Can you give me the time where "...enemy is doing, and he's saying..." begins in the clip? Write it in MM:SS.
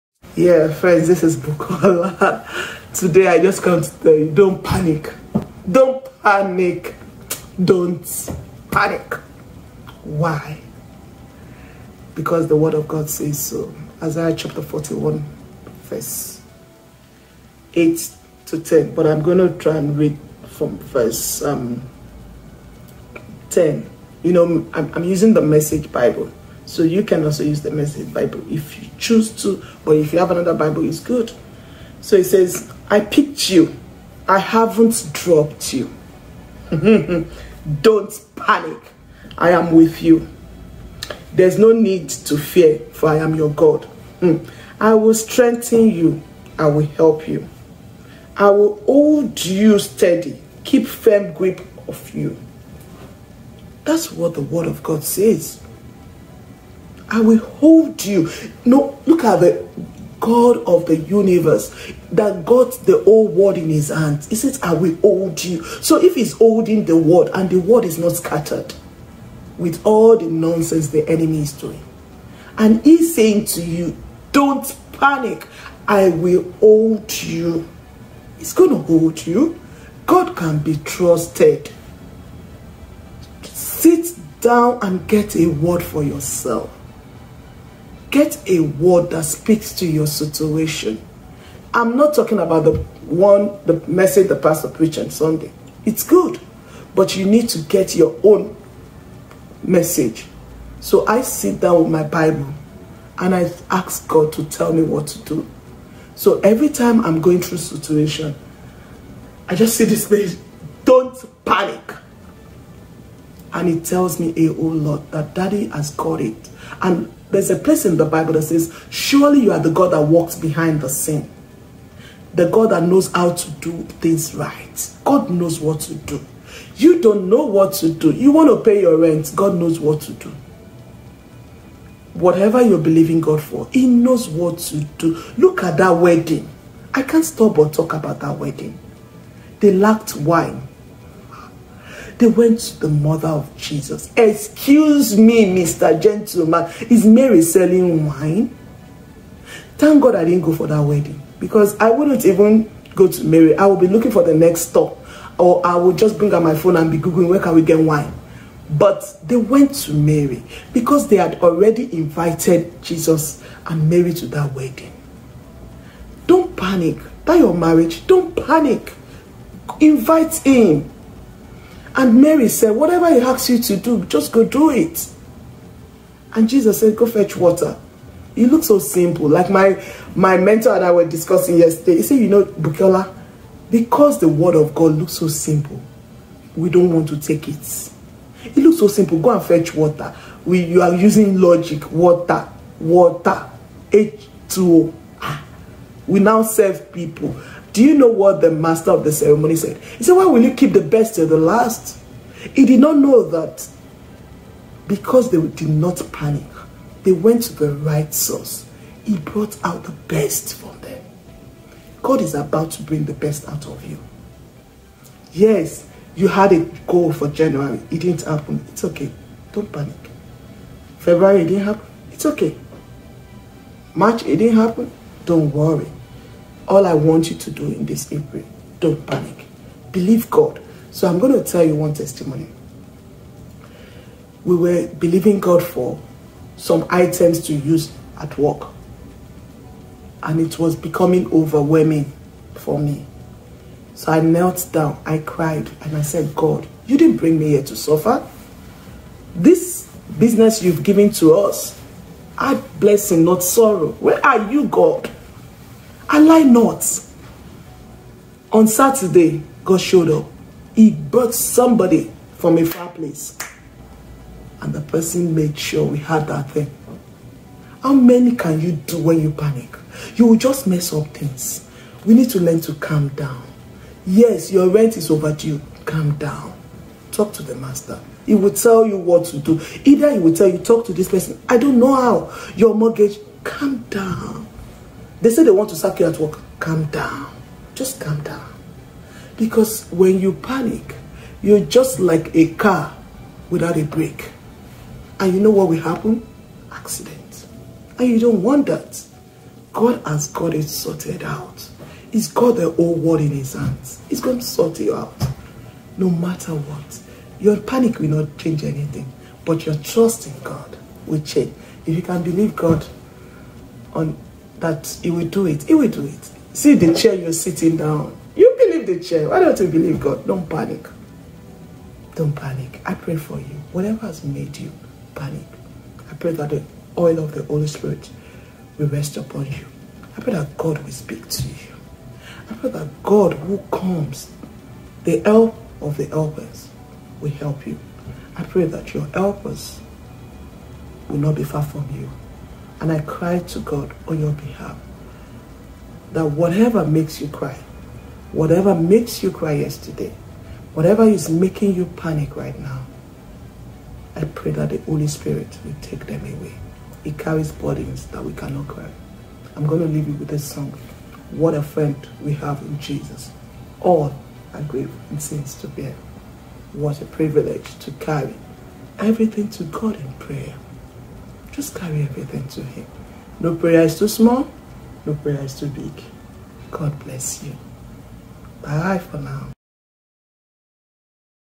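01:11.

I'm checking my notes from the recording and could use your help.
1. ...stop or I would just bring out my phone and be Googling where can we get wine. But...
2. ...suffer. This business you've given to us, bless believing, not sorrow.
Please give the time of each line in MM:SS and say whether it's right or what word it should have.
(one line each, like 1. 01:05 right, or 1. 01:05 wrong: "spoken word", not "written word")
1. 02:34 right
2. 04:07 wrong: "blessing", not "believing".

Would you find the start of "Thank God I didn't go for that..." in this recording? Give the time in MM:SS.
02:29.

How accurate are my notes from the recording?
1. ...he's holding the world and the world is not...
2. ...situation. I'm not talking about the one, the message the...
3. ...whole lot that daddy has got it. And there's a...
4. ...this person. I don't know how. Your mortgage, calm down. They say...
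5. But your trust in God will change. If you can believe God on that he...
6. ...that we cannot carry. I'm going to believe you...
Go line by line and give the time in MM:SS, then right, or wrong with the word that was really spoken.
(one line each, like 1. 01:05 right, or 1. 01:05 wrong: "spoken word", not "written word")
1. 01:06 right
2. 01:30 right
3. 01:54 right
4. 04:40 right
5. 05:09 right
6. 05:58 wrong: "leave", not "believe".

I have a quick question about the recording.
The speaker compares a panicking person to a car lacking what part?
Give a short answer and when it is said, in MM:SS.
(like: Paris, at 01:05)
A brake, at 04:53.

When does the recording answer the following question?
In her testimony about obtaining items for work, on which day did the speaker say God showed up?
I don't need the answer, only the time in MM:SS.
04:18.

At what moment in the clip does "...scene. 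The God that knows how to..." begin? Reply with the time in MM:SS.
02:00.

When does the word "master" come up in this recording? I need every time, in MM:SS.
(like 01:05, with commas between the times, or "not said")
03:18, 04:37.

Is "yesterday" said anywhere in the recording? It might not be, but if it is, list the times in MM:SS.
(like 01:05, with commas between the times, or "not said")
03:01, 05:49.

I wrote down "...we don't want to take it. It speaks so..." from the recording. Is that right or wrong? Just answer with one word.
wrong.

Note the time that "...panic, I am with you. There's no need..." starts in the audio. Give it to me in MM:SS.
00:38.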